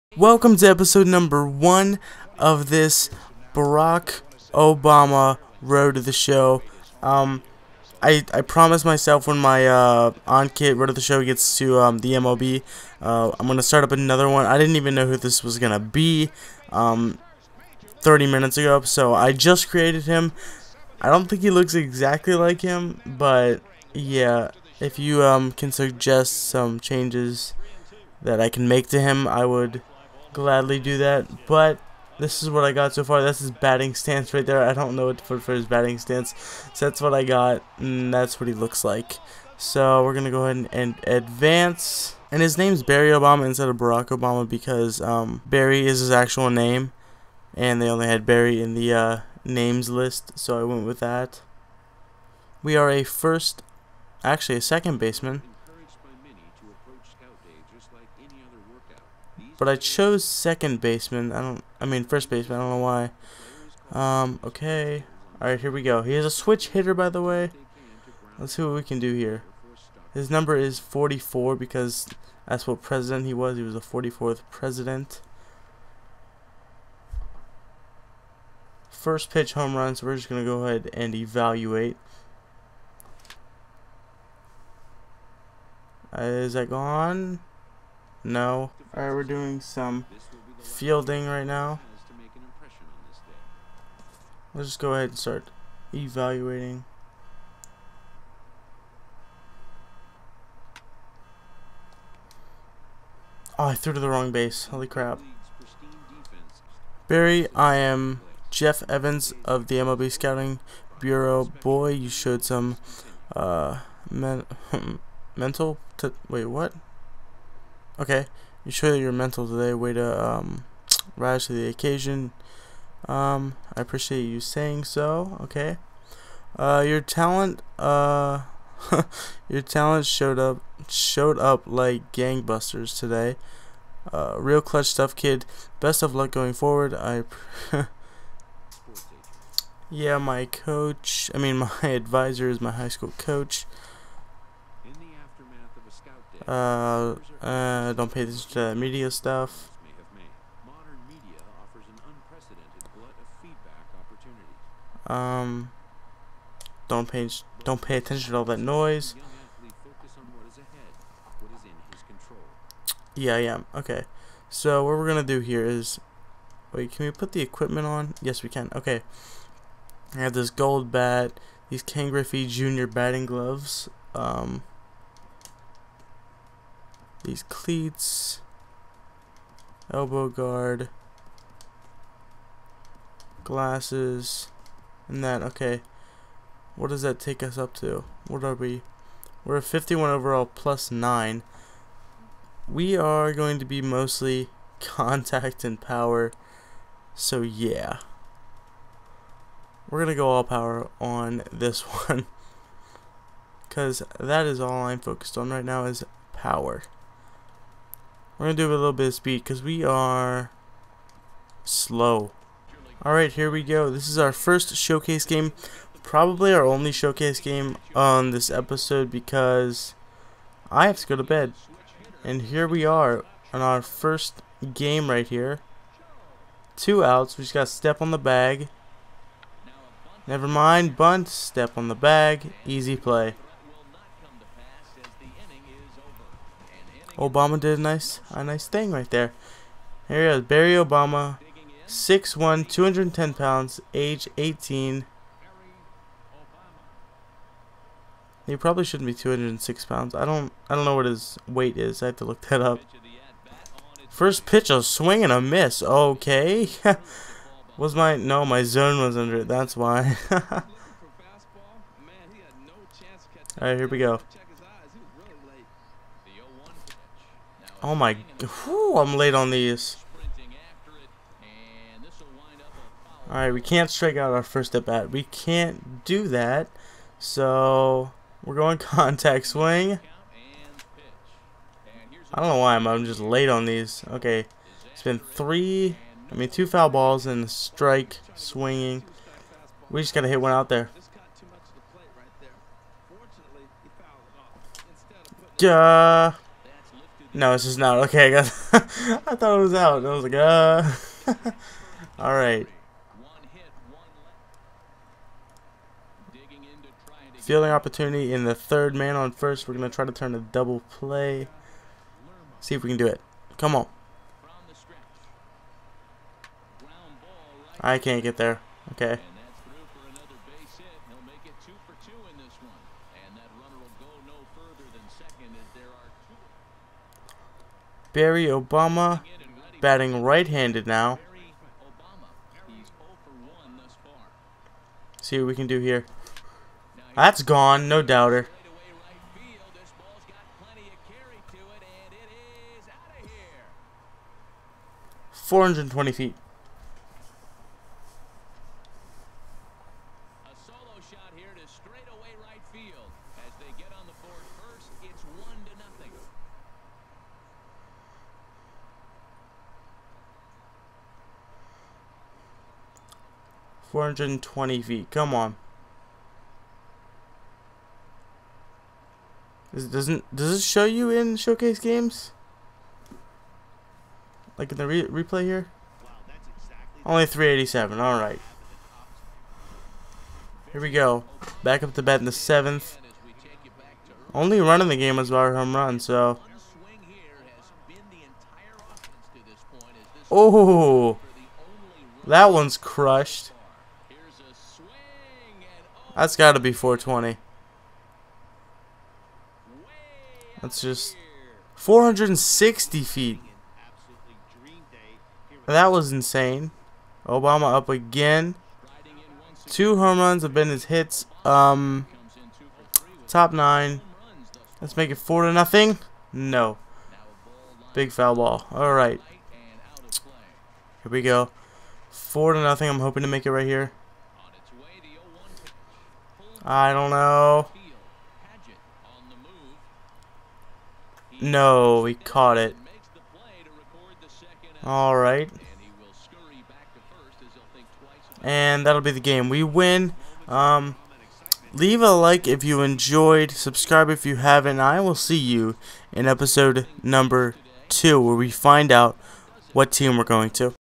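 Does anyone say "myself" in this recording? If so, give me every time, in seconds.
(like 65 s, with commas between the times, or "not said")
8 s.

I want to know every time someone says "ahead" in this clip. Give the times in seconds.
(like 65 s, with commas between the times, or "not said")
40 s, 80 s, 94 s.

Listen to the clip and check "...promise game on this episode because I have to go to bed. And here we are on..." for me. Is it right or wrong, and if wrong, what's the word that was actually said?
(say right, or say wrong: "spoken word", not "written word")
wrong: "showcase", not "promise".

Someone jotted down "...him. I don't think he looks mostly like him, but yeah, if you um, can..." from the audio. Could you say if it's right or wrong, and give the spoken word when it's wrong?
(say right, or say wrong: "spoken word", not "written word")
wrong: "exactly", not "mostly".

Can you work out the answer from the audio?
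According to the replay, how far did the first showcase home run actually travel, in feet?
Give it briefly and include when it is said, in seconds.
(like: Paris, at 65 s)
387, at 377 s.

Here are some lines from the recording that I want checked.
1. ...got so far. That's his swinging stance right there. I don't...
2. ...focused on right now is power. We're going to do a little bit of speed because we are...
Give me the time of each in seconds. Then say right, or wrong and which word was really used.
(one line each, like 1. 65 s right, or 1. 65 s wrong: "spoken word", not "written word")
1. 32 s wrong: "batting", not "swinging"
2. 204 s right.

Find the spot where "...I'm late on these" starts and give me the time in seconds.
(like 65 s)
268 s.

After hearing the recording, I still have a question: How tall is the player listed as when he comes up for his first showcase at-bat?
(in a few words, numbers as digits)
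6'1".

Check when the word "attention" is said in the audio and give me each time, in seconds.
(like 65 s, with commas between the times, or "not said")
148 s, 157 s.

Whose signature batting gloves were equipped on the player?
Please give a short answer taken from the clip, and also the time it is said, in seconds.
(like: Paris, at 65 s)
Ken Griffey Jr., at 171 s.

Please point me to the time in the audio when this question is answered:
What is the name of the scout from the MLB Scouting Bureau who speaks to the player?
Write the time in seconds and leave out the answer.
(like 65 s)
108 s.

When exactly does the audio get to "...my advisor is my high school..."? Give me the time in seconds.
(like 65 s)
141 s.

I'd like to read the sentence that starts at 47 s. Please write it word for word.
And they only had Barry in the uh, names list, so I went with that.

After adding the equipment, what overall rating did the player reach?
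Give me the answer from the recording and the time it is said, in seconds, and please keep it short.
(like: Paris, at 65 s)
51, at 189 s.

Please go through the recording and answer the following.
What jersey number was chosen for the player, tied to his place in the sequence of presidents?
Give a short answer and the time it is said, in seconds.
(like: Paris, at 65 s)
44, at 70 s.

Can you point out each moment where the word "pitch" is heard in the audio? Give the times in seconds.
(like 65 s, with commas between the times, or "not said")
79 s, 254 s.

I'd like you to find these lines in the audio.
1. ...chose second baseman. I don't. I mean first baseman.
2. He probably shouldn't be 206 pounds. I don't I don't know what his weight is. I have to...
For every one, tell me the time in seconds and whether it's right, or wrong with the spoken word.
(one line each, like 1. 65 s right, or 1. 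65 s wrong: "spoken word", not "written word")
1. 59 s right
2. 248 s right.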